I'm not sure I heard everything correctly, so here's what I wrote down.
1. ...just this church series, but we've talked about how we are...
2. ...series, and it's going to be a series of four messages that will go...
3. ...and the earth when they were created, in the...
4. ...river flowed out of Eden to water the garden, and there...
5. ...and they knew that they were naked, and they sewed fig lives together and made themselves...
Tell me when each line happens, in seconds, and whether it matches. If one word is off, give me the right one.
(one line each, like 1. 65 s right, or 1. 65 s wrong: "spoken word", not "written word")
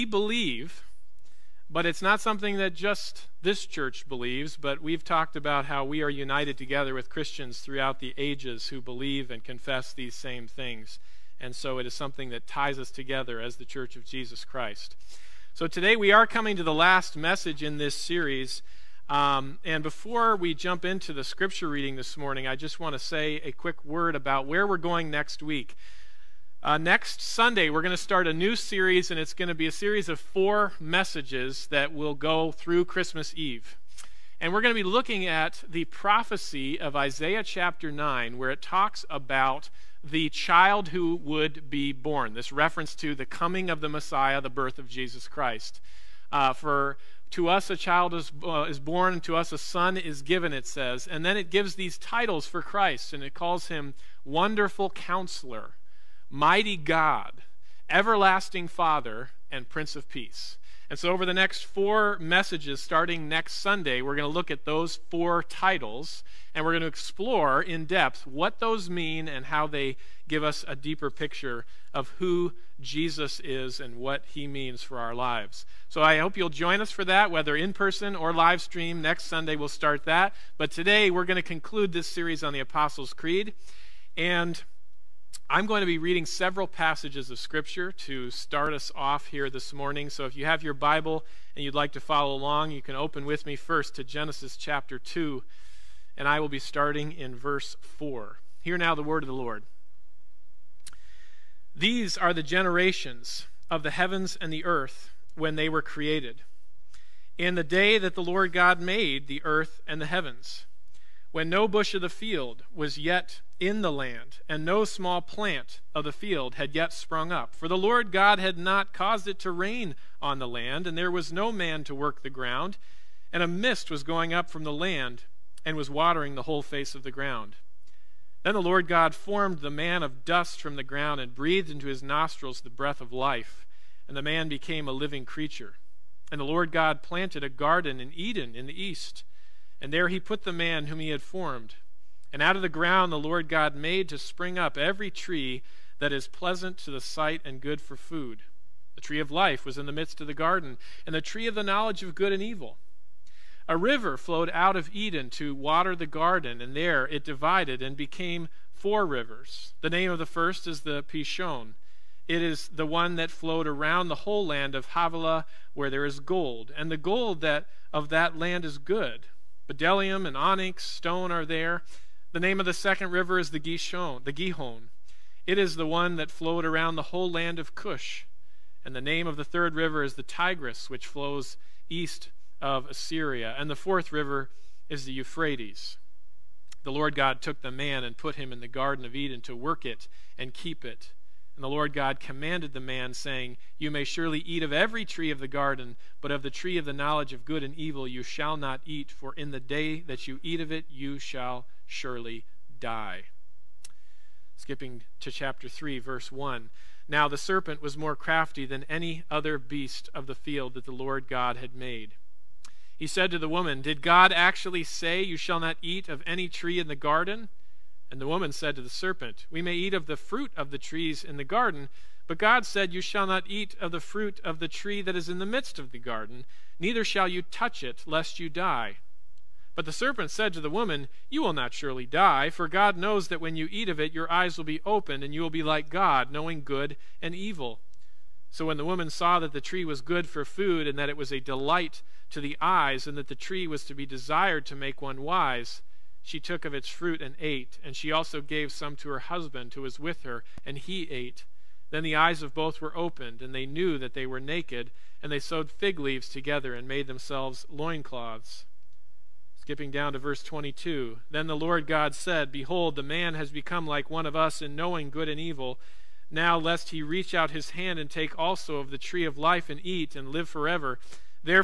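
1. 2 s wrong: "believes", not "series"
2. 28 s right
3. 104 s right
4. 153 s right
5. 253 s wrong: "leaves", not "lives".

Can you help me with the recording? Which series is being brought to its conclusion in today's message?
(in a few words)
the Apostles' Creed.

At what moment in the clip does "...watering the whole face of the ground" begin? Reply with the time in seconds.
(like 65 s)
125 s.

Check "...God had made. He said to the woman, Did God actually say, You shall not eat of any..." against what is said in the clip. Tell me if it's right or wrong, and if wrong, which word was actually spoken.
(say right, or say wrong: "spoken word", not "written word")
right.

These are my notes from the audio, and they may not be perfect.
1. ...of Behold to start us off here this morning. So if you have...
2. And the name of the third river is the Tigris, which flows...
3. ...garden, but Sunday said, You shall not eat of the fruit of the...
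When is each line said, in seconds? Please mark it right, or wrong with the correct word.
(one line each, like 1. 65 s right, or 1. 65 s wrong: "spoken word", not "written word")
1. 87 s wrong: "Scripture", not "Behold"
2. 178 s right
3. 221 s wrong: "God", not "Sunday".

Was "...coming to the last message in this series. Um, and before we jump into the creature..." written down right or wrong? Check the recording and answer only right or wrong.
wrong.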